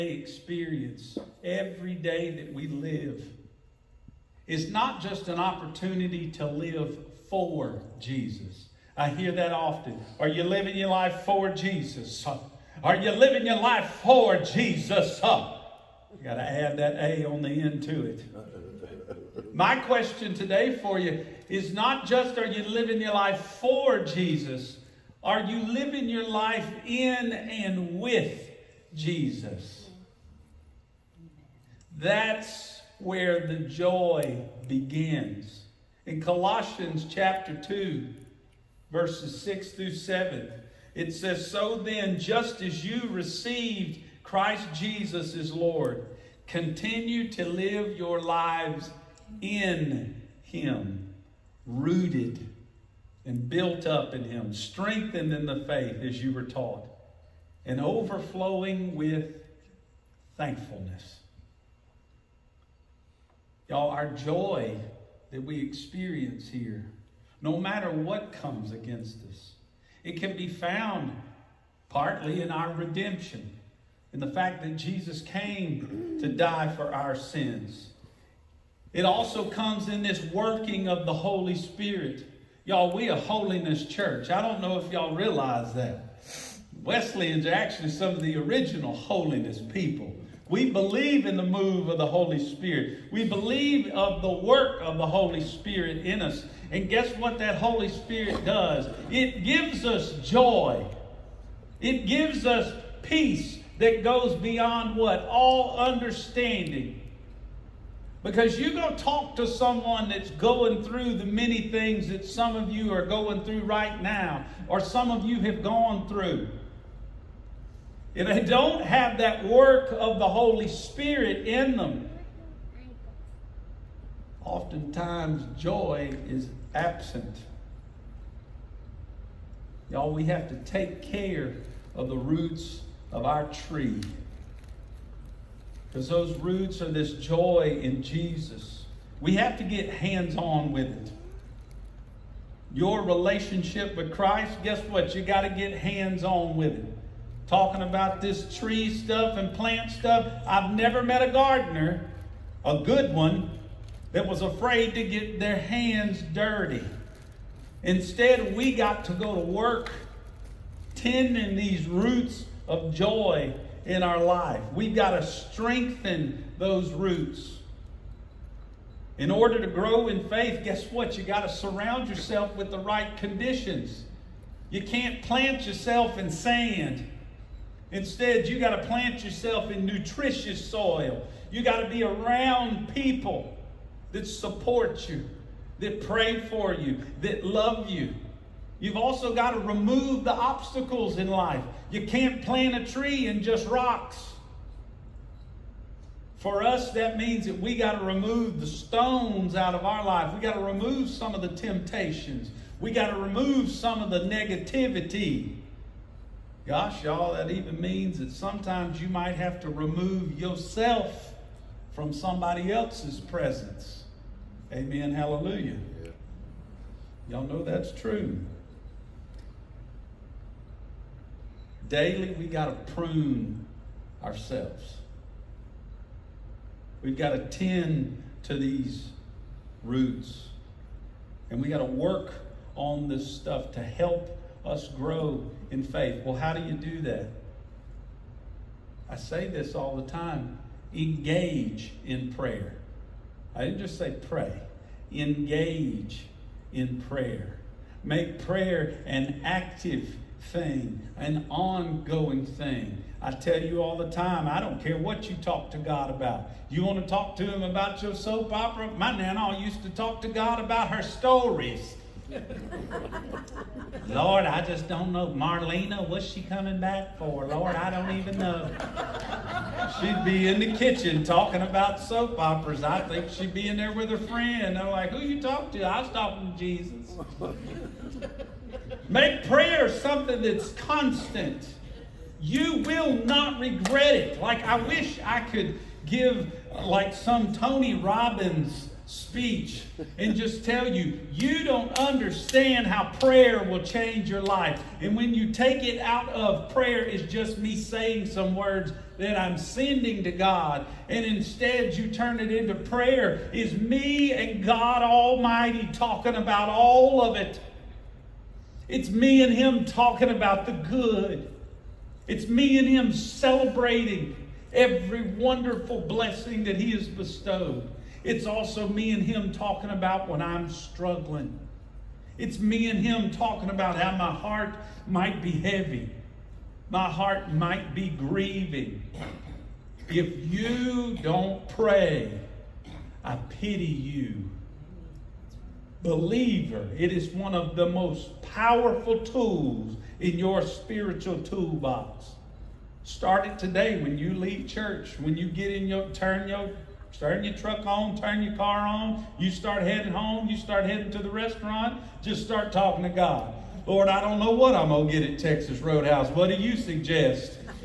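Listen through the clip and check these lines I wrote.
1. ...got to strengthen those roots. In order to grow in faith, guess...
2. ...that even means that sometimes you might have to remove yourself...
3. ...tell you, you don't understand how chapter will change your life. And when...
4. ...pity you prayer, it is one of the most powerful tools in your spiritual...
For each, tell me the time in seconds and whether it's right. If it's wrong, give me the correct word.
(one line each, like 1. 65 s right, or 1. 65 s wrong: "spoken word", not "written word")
1. 164 s right
2. 207 s right
3. 290 s wrong: "prayer", not "chapter"
4. 333 s wrong: "believer", not "prayer".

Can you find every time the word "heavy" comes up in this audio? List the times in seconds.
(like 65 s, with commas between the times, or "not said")
325 s.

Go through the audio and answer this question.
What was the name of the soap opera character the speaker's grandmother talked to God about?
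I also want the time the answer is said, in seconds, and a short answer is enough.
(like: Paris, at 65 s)
Marlena, at 265 s.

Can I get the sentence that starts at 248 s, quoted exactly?
Make prayer an active thing, an ongoing thing.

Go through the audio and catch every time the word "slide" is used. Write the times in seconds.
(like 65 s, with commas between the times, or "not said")
not said.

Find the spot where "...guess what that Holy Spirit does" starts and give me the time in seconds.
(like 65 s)
96 s.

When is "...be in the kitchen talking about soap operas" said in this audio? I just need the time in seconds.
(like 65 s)
270 s.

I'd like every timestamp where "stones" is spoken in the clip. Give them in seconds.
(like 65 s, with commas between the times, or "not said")
198 s.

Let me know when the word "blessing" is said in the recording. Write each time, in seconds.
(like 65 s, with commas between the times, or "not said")
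316 s.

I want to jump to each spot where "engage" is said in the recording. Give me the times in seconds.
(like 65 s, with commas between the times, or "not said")
240 s, 245 s.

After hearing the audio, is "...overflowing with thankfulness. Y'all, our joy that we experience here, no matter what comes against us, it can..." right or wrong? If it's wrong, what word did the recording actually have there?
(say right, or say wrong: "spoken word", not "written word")
right.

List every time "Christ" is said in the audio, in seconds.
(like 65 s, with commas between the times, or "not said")
44 s, 144 s.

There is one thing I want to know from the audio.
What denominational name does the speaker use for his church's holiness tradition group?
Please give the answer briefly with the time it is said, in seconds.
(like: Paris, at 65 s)
Wesleyans, at 86 s.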